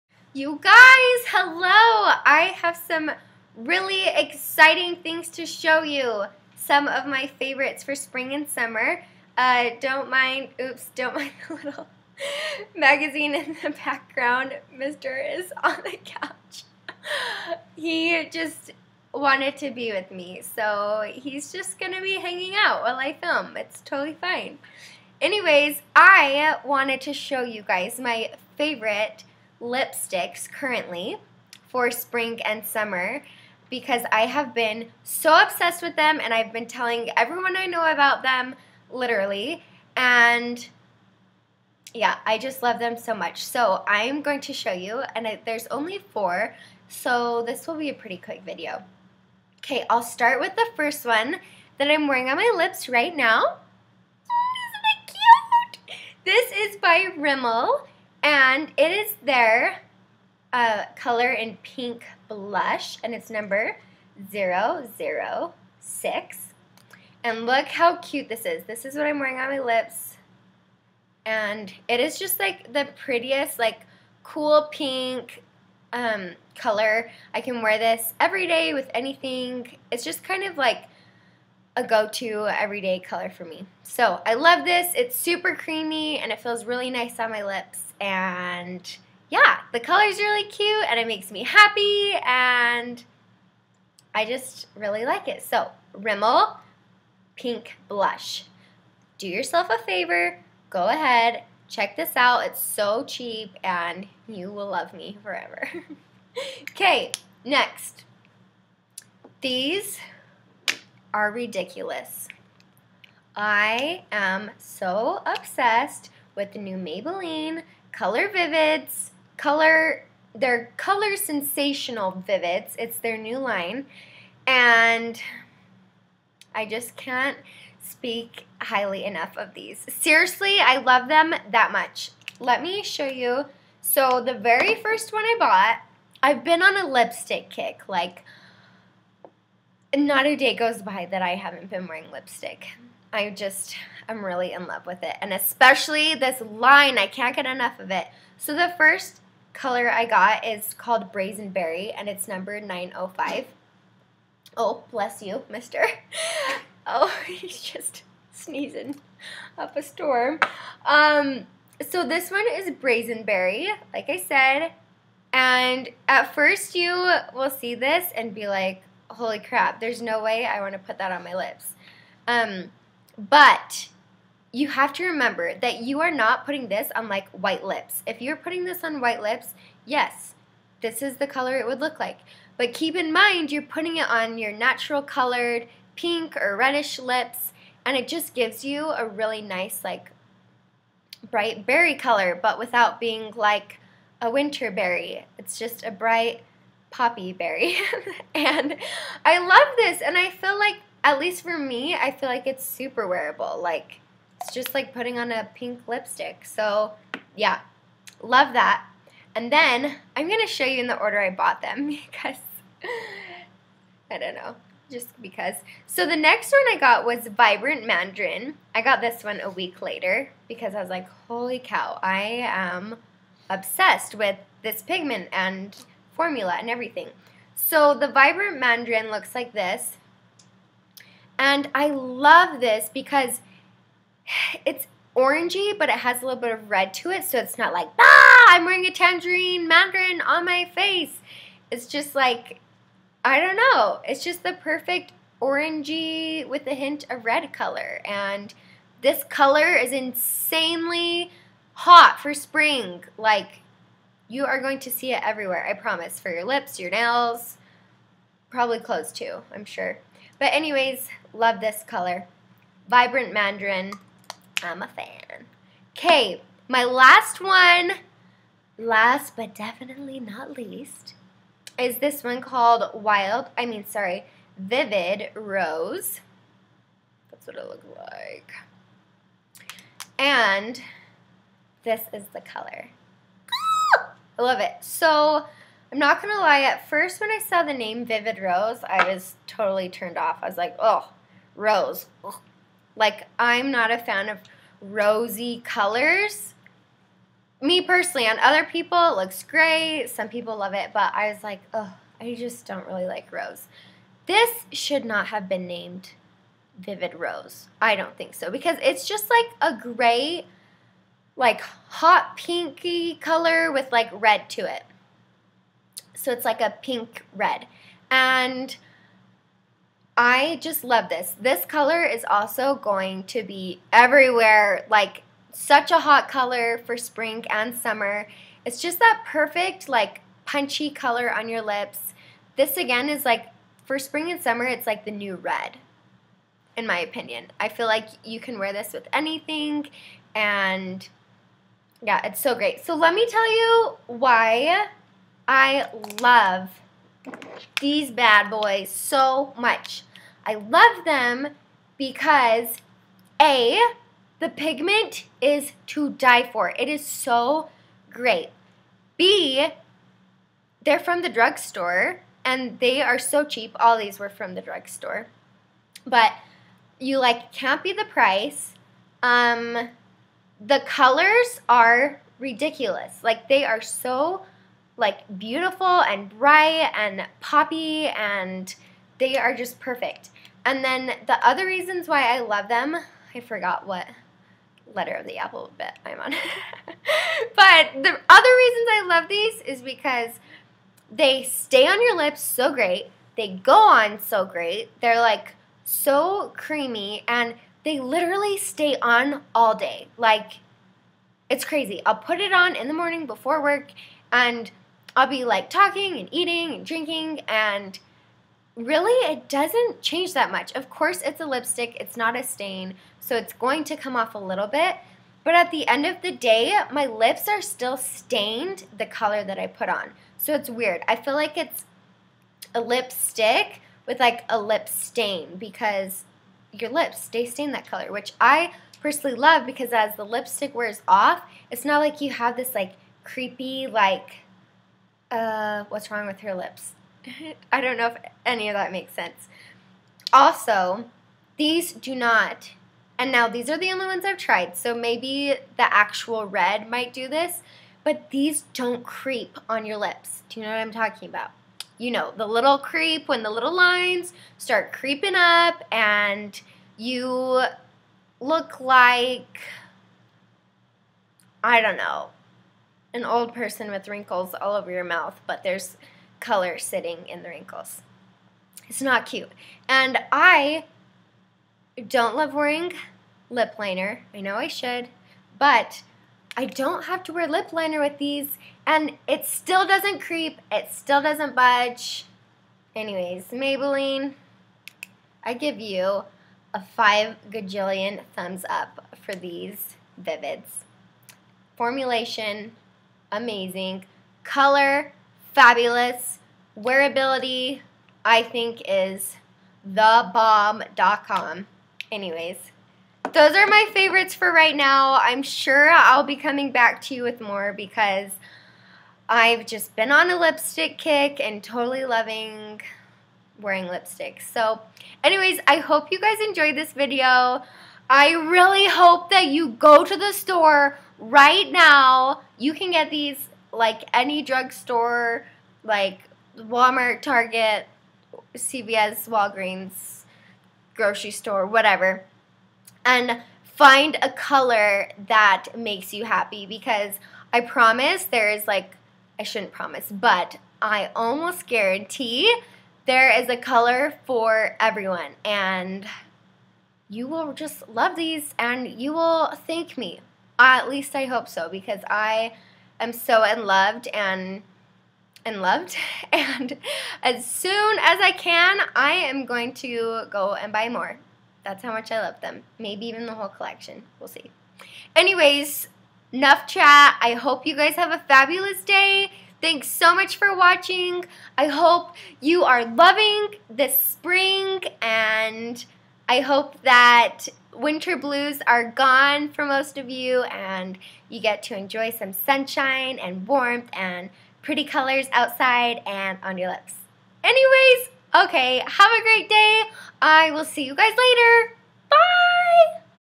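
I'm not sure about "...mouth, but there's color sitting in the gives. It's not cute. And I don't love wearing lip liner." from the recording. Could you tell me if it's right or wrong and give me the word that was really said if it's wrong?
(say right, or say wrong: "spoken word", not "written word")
wrong: "wrinkles", not "gives".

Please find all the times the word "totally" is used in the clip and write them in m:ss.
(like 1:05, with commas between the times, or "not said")
0:23, 4:49, 8:31.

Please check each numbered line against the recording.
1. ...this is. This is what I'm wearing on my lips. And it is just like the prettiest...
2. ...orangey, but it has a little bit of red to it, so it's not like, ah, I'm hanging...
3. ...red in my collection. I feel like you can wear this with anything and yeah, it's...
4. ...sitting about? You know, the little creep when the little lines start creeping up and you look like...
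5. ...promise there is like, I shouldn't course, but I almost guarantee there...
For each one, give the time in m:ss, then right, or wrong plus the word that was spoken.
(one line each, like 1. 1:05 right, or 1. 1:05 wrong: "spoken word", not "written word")
1. 1:08 right
2. 3:55 wrong: "wearing", not "hanging"
3. 5:35 wrong: "opinion", not "collection"
4. 7:30 wrong: "talking", not "sitting"
5. 8:57 wrong: "promise", not "course".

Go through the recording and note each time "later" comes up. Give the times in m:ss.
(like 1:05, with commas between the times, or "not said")
3:39, 9:51.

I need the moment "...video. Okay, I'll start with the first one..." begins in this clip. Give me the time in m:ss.
0:48.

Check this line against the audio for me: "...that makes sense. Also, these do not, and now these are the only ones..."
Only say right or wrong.
right.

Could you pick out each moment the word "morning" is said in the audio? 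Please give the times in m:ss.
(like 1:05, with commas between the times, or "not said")
6:42.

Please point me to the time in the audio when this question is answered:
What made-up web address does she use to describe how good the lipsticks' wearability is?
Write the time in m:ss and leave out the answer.
8:19.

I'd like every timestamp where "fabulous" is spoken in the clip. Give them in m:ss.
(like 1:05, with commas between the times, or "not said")
8:15, 9:28.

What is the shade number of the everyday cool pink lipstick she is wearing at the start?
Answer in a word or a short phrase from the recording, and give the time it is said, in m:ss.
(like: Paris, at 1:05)
006, at 1:04.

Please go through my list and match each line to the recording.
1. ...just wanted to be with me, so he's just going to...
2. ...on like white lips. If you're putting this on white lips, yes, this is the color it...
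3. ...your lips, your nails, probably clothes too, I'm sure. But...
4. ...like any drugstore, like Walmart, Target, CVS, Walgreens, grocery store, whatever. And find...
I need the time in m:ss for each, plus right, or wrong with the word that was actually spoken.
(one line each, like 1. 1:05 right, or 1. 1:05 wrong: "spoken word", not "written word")
1. 0:18 right
2. 2:56 right
3. 4:16 right
4. 8:43 right.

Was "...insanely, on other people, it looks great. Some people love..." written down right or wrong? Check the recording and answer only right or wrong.
wrong.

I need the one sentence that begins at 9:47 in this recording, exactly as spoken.
Anyways, okay, have a great day.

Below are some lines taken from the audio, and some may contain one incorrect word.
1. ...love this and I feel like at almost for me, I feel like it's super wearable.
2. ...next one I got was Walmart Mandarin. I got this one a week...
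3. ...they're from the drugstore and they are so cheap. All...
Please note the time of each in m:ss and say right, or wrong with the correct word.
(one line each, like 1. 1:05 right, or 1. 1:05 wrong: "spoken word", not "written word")
1. 3:19 wrong: "least", not "almost"
2. 3:36 wrong: "Vibrant", not "Walmart"
3. 6:00 right.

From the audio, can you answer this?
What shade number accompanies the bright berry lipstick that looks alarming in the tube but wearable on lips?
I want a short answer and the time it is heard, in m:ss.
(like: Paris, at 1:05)
905, at 2:32.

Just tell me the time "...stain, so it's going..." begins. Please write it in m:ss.
6:52.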